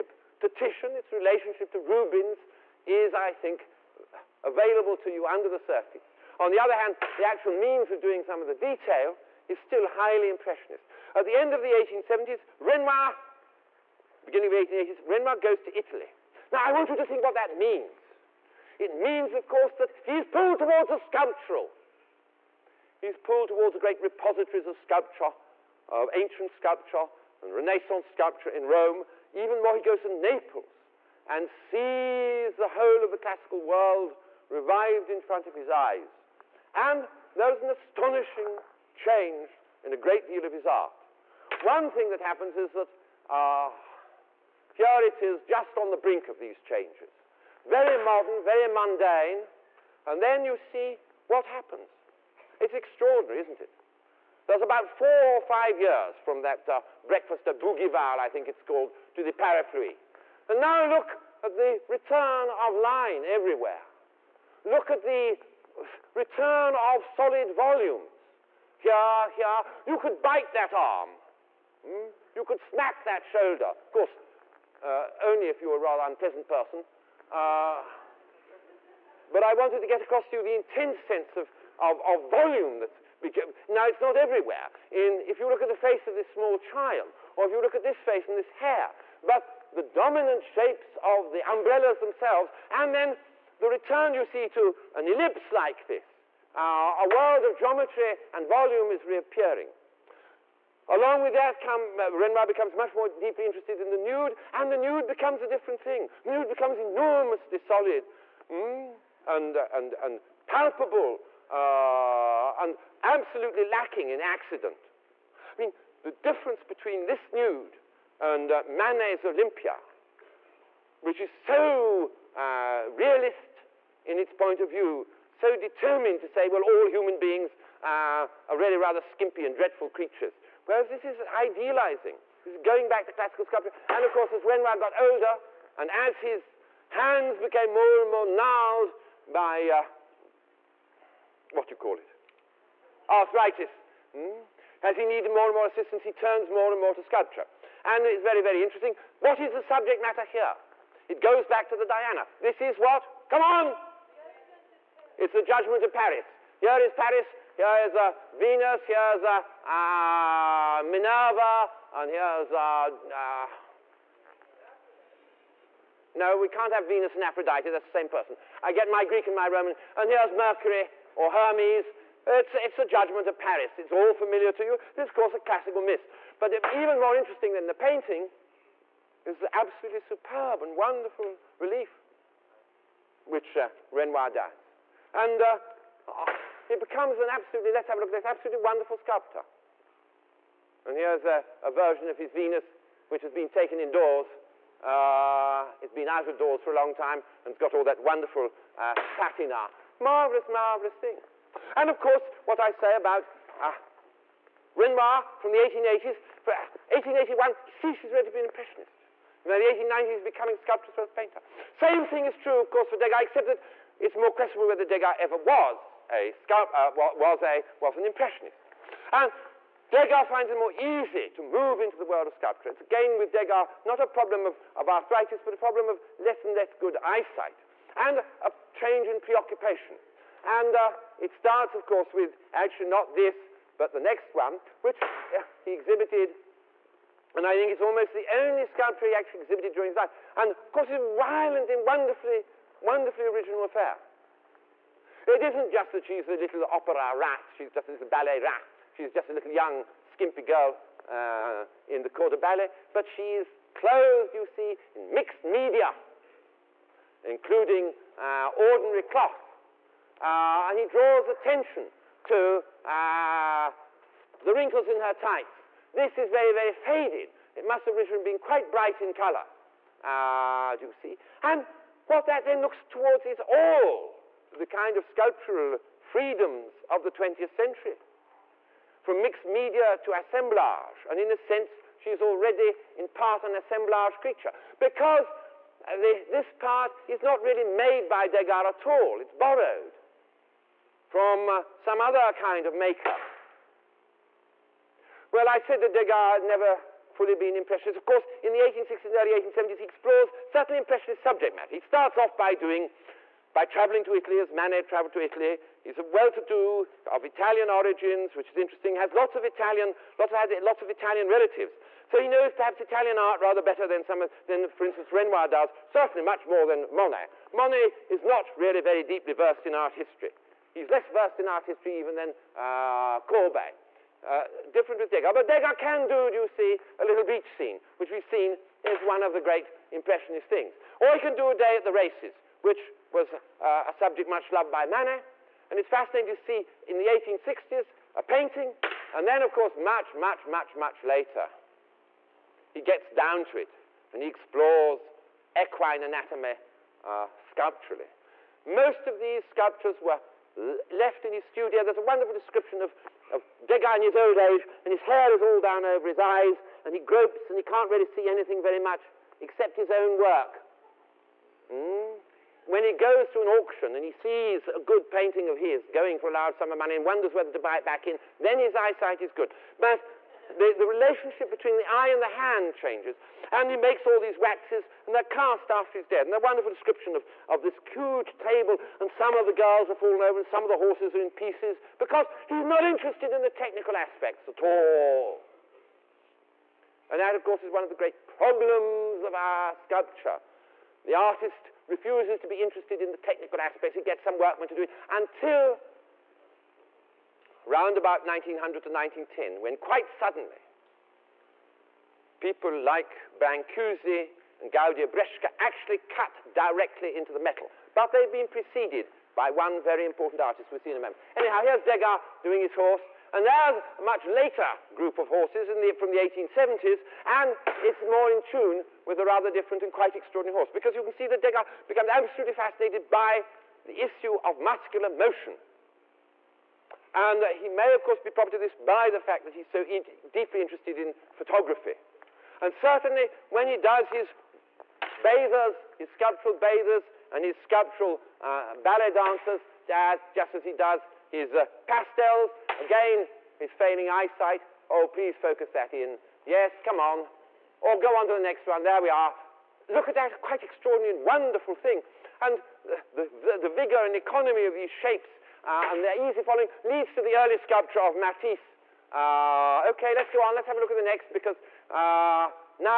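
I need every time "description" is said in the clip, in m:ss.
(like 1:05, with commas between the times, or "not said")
5:52, 6:16.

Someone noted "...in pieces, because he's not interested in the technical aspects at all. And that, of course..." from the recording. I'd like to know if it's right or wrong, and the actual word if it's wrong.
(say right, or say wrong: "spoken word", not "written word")
right.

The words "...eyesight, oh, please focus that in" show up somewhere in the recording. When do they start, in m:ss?
7:24.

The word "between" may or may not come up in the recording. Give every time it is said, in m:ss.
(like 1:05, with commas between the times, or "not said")
1:56, 6:11.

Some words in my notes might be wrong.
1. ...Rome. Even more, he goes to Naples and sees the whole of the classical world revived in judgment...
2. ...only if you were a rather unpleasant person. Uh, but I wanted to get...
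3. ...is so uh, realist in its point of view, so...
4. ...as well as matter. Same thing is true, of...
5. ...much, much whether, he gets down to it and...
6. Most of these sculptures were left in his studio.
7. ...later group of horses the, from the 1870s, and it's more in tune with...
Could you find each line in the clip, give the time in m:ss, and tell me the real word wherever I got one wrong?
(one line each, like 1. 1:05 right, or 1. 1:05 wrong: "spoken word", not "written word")
1. 0:28 wrong: "front", not "judgment"
2. 1:15 right
3. 2:01 right
4. 3:30 wrong: "painter", not "matter"
5. 5:40 wrong: "later", not "whether"
6. 5:48 right
7. 6:54 right.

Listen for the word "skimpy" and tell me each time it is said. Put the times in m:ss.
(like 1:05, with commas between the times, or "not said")
2:09, 4:10.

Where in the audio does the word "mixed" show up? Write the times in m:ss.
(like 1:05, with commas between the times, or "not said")
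4:15, 4:39.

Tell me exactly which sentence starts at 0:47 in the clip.
Very modern, very mundane, and then you see what happens.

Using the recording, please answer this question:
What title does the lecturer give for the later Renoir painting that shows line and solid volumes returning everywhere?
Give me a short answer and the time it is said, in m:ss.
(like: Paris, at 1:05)
Parapluie, at 0:59.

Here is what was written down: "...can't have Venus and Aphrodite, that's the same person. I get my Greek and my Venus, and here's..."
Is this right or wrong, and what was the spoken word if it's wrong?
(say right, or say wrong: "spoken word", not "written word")
wrong: "Roman", not "Venus".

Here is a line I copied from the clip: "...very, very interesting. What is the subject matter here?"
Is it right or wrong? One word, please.
right.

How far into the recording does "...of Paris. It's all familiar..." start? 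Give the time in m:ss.
2:53.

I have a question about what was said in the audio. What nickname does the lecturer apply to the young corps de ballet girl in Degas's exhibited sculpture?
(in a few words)
ballet rat.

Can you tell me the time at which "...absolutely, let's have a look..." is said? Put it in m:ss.
3:07.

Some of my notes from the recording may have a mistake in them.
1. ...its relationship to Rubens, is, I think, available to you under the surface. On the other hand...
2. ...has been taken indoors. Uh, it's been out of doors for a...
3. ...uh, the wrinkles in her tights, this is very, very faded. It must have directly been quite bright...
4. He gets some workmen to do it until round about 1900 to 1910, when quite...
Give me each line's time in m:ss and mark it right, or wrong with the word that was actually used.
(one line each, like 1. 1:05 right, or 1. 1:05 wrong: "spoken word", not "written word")
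1. 0:00 right
2. 3:13 right
3. 4:22 wrong: "originally", not "directly"
4. 6:33 right.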